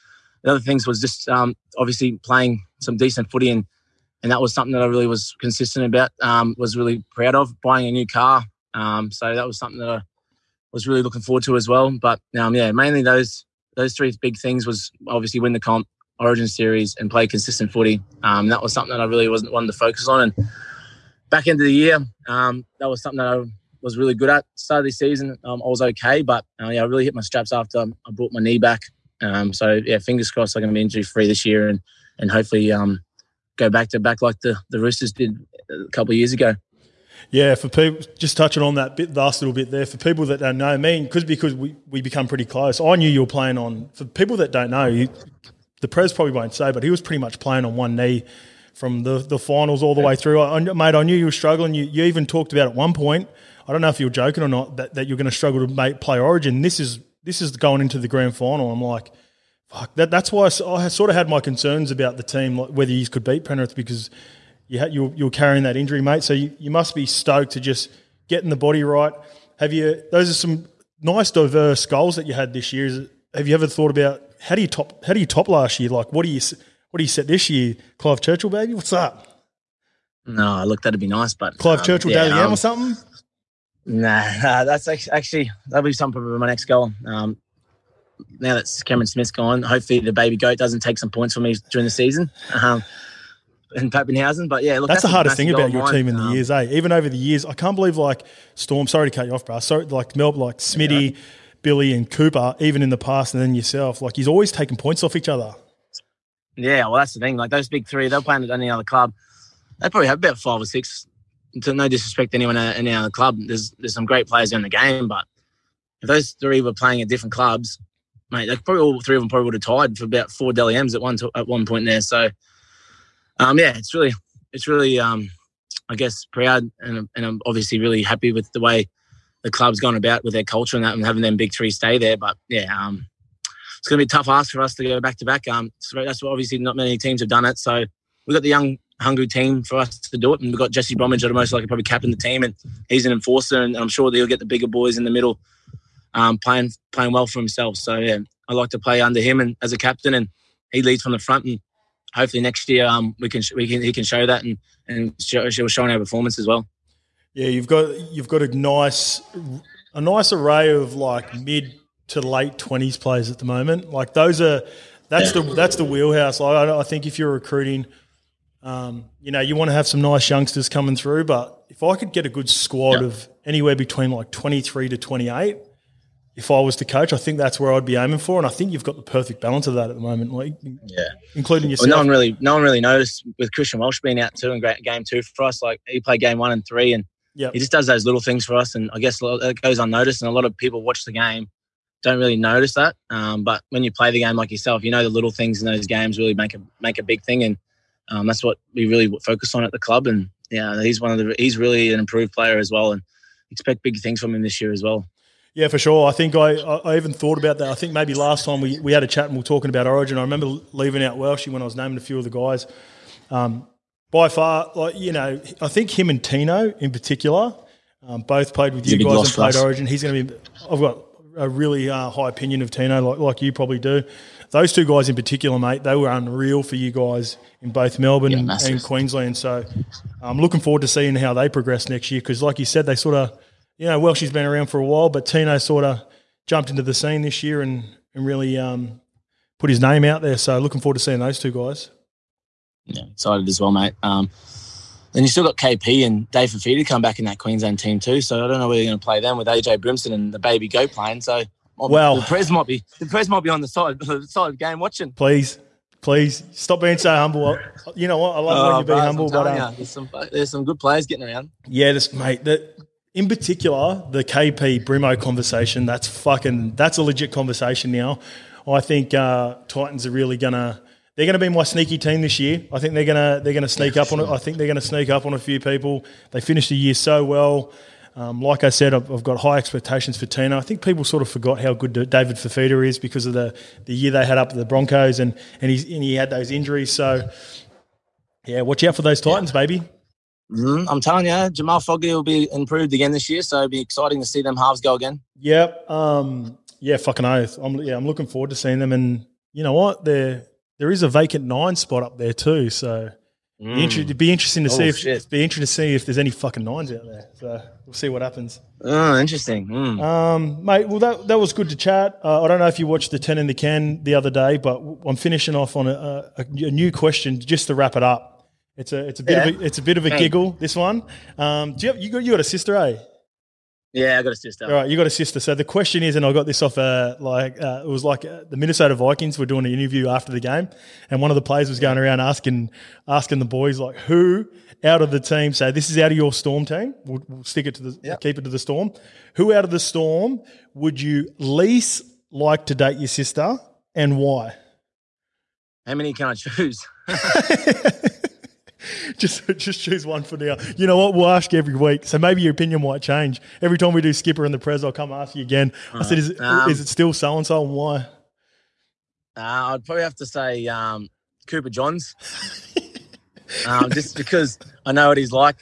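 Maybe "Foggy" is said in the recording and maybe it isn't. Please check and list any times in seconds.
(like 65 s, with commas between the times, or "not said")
291 s.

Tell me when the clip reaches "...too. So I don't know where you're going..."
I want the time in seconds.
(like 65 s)
248 s.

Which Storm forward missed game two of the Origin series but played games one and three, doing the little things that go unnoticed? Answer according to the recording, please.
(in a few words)
Christian Welch.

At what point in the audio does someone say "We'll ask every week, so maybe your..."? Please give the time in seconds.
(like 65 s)
351 s.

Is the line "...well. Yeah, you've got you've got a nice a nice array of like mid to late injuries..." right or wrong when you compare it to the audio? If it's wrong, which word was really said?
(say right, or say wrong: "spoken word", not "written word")
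wrong: "twenties", not "injuries".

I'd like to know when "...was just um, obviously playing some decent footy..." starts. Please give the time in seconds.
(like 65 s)
0 s.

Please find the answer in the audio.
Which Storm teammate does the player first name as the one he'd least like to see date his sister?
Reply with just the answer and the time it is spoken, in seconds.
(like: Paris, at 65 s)
Cooper Johns, at 361 s.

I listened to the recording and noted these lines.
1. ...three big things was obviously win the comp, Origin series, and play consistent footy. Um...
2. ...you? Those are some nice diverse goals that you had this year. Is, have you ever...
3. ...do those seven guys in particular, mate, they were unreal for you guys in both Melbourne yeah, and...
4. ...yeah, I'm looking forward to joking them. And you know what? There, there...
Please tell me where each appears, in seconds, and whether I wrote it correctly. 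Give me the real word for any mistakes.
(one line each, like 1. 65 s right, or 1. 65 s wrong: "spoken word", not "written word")
1. 13 s right
2. 69 s right
3. 223 s wrong: "two", not "seven"
4. 297 s wrong: "seeing", not "joking".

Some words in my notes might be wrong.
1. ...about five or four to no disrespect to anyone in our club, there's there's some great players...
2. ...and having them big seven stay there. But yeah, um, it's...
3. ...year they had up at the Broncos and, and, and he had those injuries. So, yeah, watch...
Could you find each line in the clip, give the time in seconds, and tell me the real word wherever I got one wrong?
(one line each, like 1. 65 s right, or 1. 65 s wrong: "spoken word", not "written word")
1. 110 s wrong: "six", not "four"
2. 130 s wrong: "three", not "seven"
3. 283 s right.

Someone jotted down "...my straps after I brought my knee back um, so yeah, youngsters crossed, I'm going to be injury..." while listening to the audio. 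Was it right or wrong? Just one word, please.
wrong.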